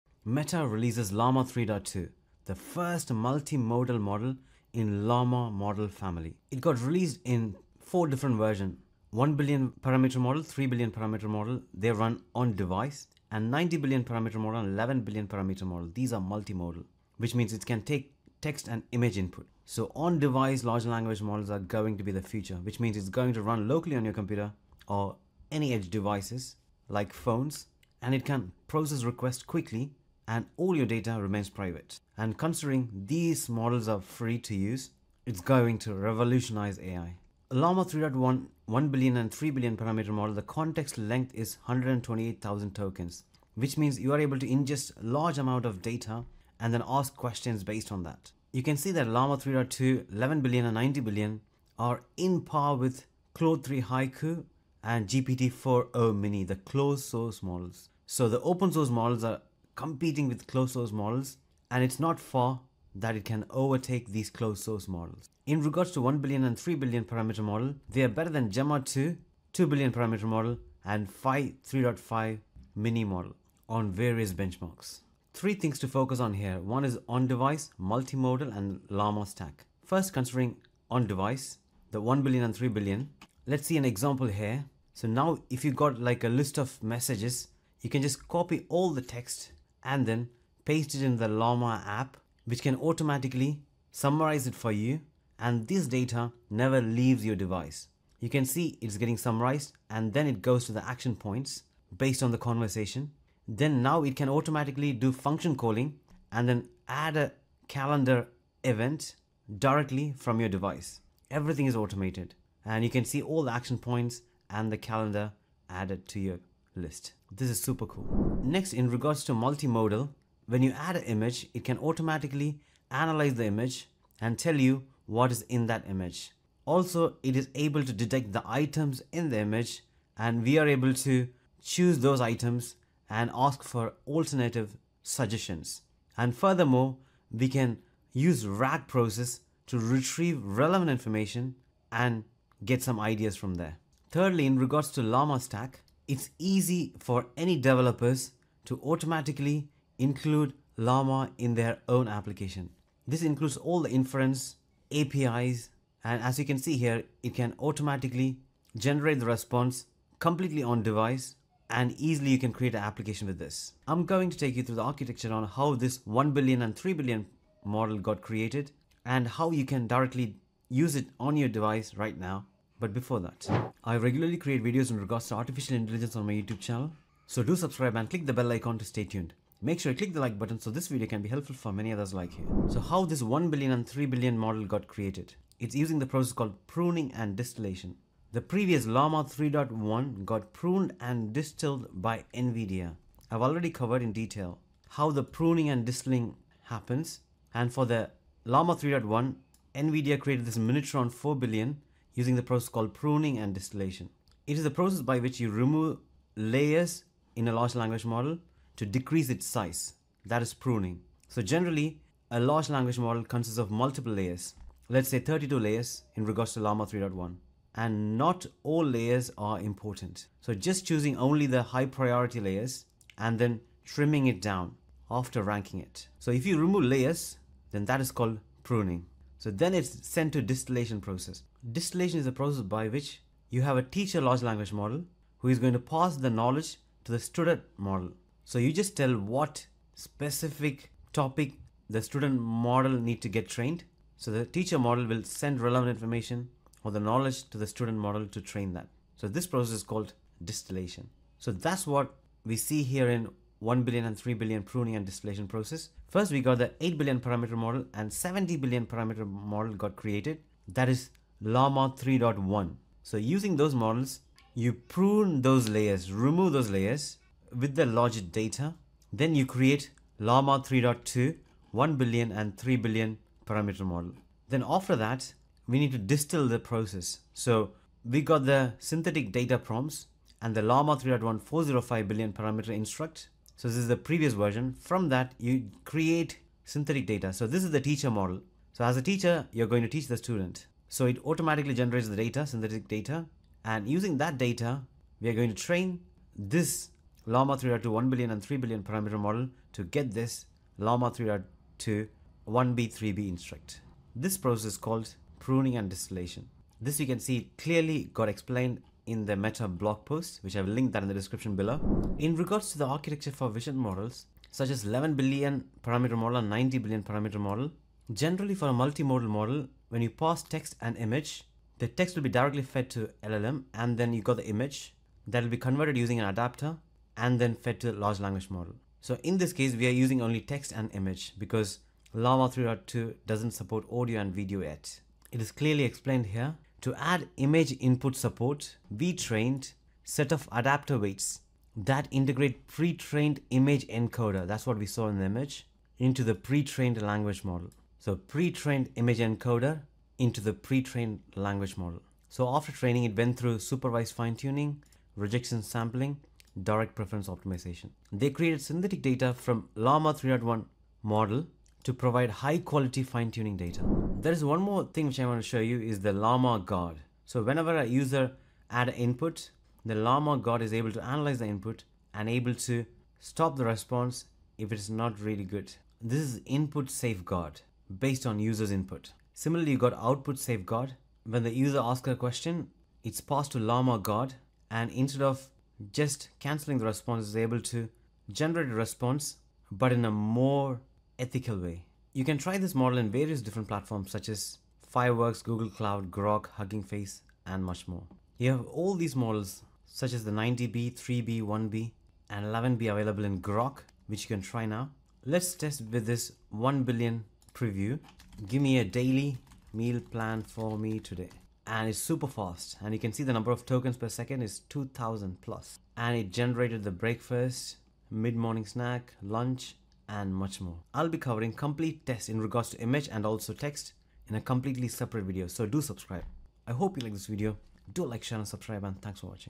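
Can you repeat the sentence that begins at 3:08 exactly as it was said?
The previous Llama 3.1 got pruned and distilled by NVIDIA.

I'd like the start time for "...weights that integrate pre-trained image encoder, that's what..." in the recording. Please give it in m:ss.
5:40.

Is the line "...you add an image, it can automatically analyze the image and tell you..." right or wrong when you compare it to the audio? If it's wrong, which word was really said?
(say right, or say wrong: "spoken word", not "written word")
right.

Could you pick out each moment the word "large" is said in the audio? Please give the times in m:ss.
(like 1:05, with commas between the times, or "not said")
0:20, 0:45, 3:27, 3:32, 3:54, 5:27.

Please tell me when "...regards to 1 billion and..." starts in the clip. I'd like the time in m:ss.
1:05.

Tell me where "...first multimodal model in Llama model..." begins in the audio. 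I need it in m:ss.
0:02.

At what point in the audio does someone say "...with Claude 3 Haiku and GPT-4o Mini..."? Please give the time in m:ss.
0:52.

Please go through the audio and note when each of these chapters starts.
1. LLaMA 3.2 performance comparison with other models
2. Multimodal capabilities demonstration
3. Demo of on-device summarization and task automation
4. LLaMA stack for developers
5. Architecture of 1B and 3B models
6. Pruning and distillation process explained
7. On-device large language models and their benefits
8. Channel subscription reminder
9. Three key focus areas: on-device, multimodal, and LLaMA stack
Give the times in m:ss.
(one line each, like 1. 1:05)
1. 0:39
2. 2:00
3. 1:25
4. 2:24
5. 3:02
6. 3:50
7. 0:20
8. 2:51
9. 1:15.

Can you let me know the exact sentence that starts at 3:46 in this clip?
So if you remove layers, then that is called pruning.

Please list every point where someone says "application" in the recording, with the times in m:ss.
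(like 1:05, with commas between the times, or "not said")
2:32, 2:42.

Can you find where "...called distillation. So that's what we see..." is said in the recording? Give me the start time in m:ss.
4:09.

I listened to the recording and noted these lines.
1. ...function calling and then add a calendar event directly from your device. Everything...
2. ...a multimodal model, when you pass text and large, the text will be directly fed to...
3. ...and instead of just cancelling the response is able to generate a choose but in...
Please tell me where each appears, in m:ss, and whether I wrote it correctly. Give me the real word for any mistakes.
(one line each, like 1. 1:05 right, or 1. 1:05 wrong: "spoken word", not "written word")
1. 1:45 right
2. 5:18 wrong: "image", not "large"
3. 6:24 wrong: "response", not "choose".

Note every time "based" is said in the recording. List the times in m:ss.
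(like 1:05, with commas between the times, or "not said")
0:47, 1:41, 6:17.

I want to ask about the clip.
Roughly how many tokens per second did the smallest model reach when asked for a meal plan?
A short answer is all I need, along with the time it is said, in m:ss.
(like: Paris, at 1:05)
2000, at 6:54.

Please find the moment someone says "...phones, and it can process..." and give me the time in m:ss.
0:27.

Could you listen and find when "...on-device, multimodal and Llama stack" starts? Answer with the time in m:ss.
1:17.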